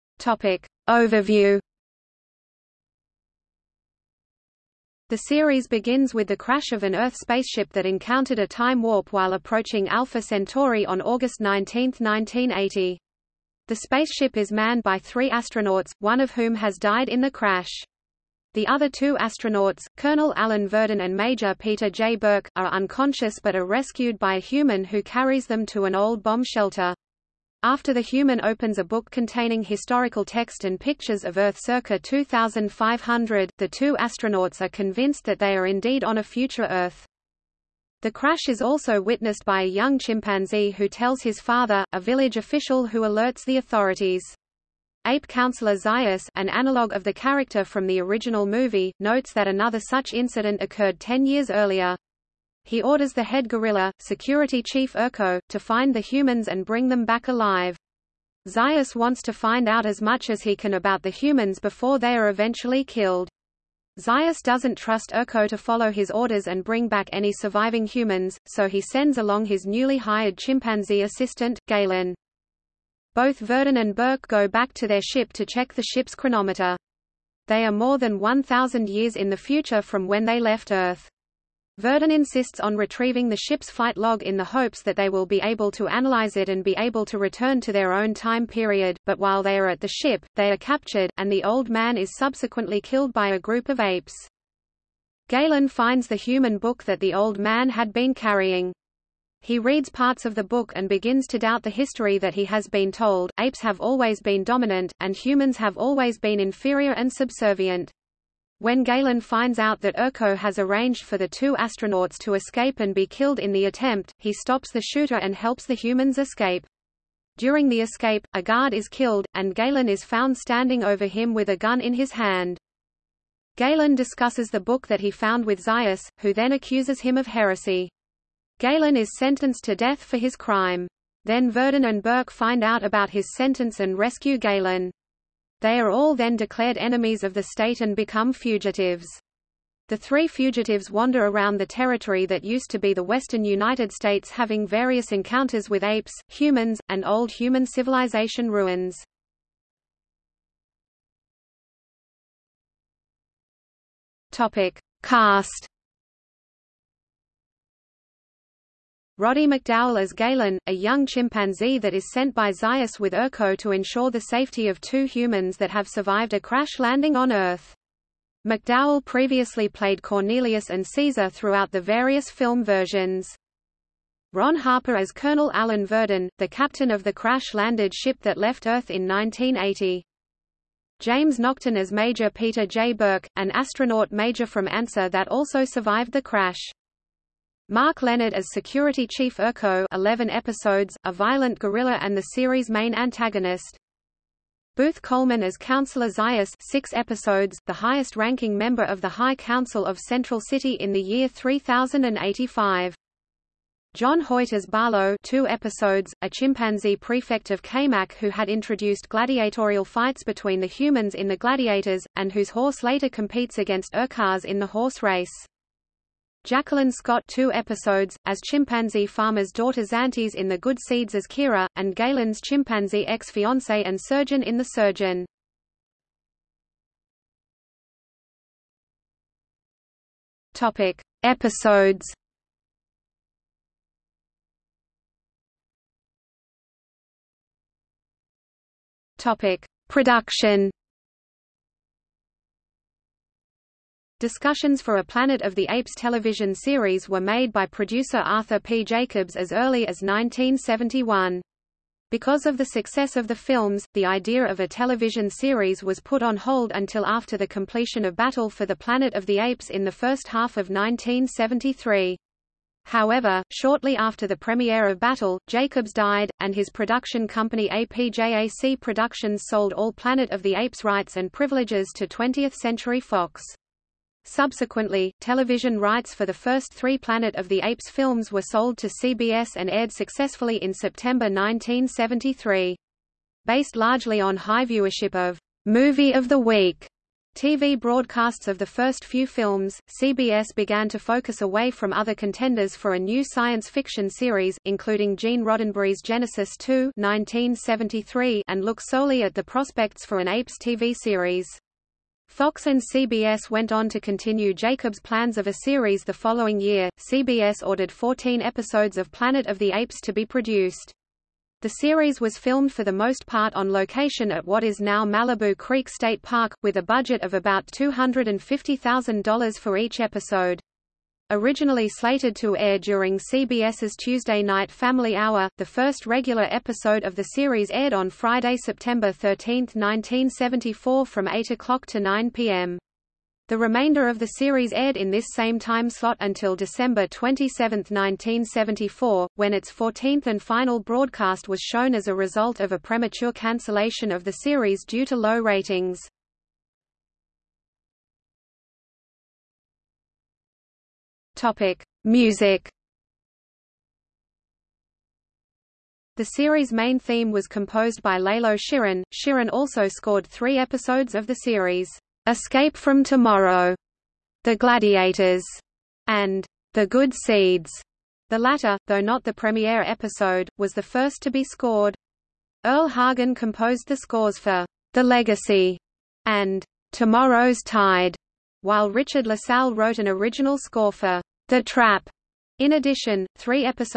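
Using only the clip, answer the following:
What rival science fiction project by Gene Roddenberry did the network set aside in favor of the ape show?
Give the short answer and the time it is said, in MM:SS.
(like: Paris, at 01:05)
Genesis 2, at 04:56.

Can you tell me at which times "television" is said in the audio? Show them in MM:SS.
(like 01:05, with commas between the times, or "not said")
04:05, 04:14, 04:35.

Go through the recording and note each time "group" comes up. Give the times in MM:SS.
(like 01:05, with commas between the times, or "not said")
01:33.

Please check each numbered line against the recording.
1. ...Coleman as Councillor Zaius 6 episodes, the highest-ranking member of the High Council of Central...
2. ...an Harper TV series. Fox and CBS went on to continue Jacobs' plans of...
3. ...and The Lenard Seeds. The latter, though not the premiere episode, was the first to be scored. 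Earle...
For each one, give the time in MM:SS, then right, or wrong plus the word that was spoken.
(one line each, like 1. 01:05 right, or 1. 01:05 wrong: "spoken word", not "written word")
1. 03:15 right
2. 05:00 wrong: "Apes", not "Harper"
3. 06:06 wrong: "Good", not "Lenard".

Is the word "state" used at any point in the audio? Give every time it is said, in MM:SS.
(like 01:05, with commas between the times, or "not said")
02:17, 02:23, 05:15.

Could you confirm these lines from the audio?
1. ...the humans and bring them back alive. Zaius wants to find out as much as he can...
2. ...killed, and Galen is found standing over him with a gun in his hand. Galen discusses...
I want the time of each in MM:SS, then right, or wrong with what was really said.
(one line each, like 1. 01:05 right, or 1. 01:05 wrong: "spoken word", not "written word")
1. 00:55 right
2. 01:58 right.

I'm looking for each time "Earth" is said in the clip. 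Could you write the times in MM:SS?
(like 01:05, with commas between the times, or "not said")
00:06, 00:31, 00:36, 01:20, 02:47, 02:58.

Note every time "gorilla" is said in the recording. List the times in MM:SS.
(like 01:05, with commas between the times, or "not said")
00:53, 03:11.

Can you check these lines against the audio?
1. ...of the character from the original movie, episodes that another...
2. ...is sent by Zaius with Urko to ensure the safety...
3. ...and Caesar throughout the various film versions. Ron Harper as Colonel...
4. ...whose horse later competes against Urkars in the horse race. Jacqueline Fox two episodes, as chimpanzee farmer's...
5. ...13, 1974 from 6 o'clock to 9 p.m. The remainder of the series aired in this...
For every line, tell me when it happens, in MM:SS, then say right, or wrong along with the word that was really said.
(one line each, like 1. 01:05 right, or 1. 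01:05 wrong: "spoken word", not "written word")
1. 00:46 wrong: "notes", not "episodes"
2. 02:41 right
3. 02:50 right
4. 03:32 wrong: "Scott", not "Fox"
5. 05:29 wrong: "8", not "6".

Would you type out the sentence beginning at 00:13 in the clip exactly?
The spaceship is manned by three astronauts, one of whom has died in the crash.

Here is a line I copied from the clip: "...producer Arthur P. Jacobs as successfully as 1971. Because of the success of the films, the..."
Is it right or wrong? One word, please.
wrong.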